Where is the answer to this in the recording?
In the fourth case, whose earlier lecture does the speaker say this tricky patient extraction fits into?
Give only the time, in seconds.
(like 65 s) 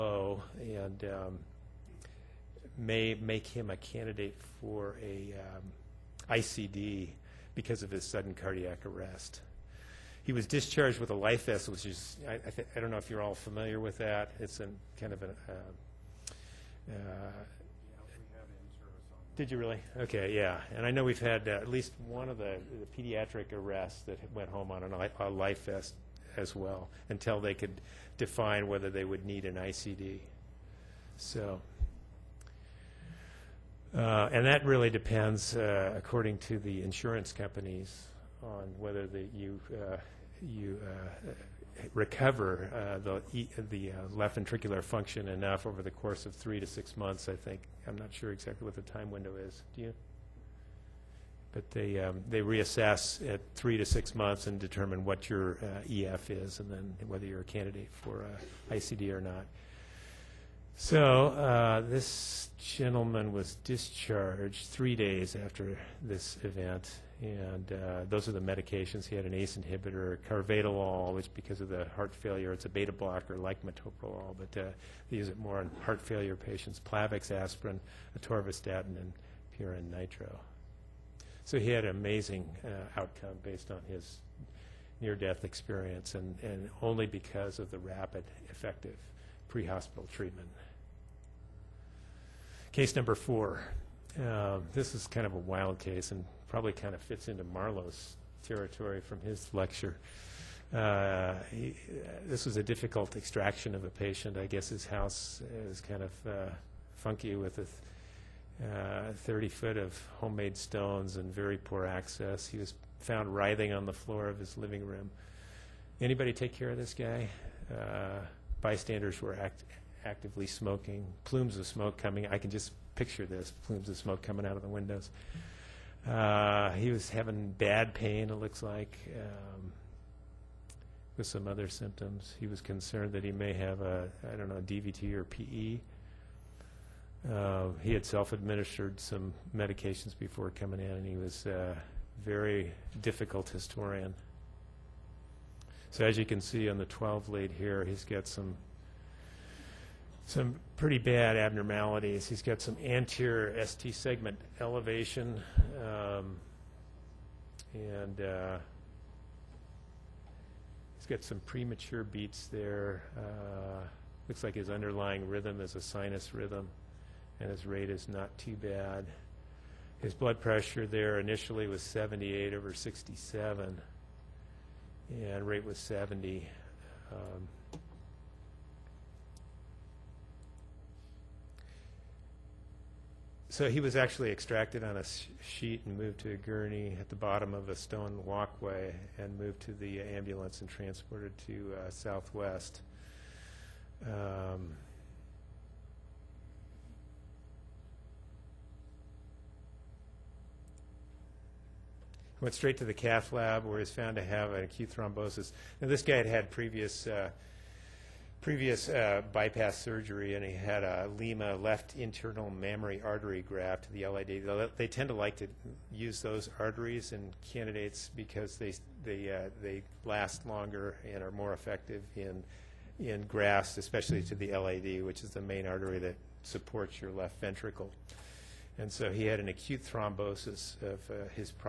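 97 s.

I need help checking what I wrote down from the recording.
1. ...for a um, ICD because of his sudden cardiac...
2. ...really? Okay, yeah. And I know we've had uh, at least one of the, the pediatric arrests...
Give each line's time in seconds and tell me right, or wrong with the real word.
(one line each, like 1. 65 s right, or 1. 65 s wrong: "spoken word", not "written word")
1. 4 s right
2. 19 s right.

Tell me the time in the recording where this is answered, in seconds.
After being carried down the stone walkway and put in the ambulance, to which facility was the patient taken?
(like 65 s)
191 s.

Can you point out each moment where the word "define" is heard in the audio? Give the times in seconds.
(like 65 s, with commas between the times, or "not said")
28 s.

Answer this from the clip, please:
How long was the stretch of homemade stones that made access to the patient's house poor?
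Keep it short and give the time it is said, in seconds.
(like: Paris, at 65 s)
30 feet, at 109 s.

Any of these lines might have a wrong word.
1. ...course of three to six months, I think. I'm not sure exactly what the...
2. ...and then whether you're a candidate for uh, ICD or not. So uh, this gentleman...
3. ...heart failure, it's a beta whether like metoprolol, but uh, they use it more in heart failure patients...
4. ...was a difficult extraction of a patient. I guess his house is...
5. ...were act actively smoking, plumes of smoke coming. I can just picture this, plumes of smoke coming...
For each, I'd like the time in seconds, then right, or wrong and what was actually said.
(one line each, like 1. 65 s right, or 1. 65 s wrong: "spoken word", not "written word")
1. 45 s right
2. 56 s right
3. 71 s wrong: "blocker", not "whether"
4. 102 s right
5. 119 s right.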